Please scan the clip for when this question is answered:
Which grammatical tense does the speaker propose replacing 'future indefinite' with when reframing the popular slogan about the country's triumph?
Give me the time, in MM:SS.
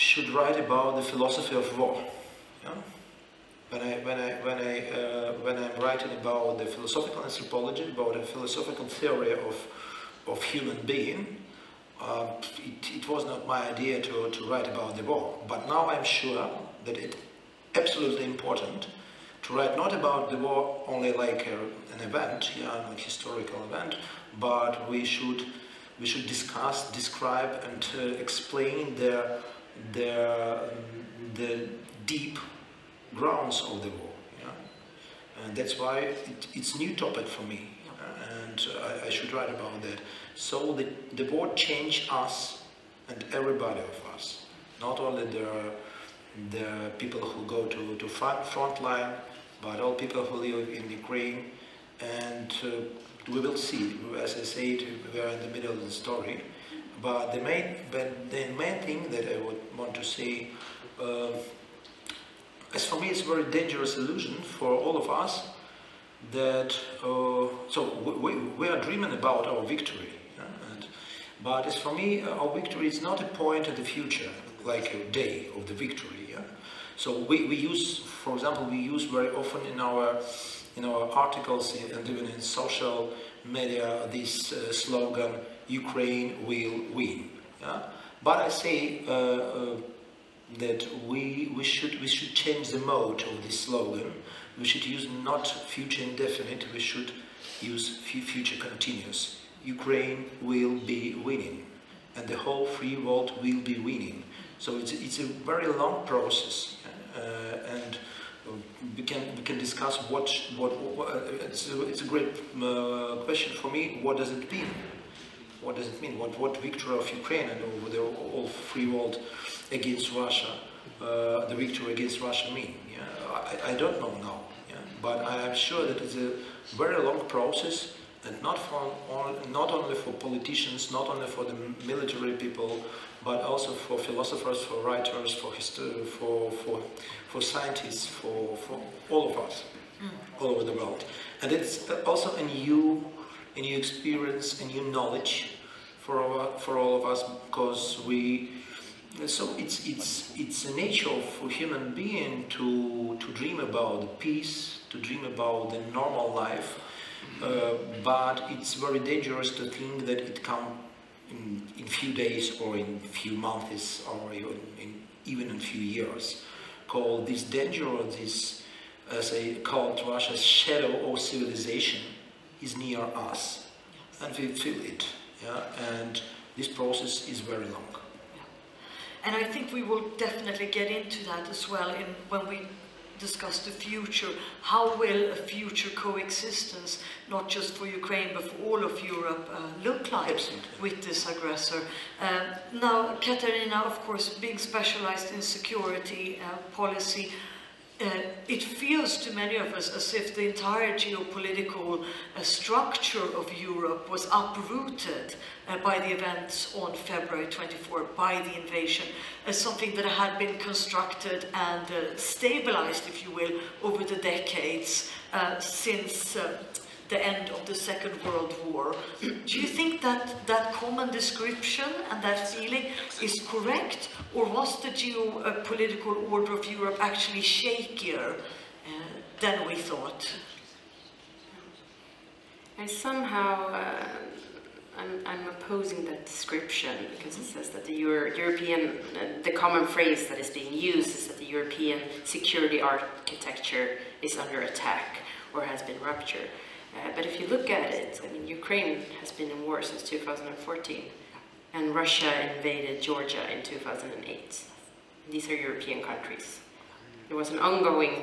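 01:37.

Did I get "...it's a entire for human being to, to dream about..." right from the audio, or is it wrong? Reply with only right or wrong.
wrong.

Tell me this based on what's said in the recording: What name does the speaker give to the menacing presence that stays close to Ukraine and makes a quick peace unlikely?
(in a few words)
Russia's shadow.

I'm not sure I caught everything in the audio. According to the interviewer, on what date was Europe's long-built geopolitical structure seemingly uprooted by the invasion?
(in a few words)
February 24.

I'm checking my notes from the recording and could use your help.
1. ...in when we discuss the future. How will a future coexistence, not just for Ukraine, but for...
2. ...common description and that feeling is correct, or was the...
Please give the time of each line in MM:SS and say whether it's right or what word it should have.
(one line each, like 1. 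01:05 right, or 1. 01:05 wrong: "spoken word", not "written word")
1. 03:01 right
2. 03:40 right.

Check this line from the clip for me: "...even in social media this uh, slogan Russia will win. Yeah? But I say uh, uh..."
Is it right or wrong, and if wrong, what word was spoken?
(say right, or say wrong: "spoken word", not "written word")
wrong: "Ukraine", not "Russia".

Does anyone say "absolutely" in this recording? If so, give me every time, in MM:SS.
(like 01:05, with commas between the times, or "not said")
00:17, 03:10.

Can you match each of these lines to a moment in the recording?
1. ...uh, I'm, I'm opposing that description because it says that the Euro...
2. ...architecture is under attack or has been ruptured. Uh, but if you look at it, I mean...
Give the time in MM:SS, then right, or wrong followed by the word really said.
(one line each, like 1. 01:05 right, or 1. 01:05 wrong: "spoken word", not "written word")
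1. 03:53 right
2. 04:02 right.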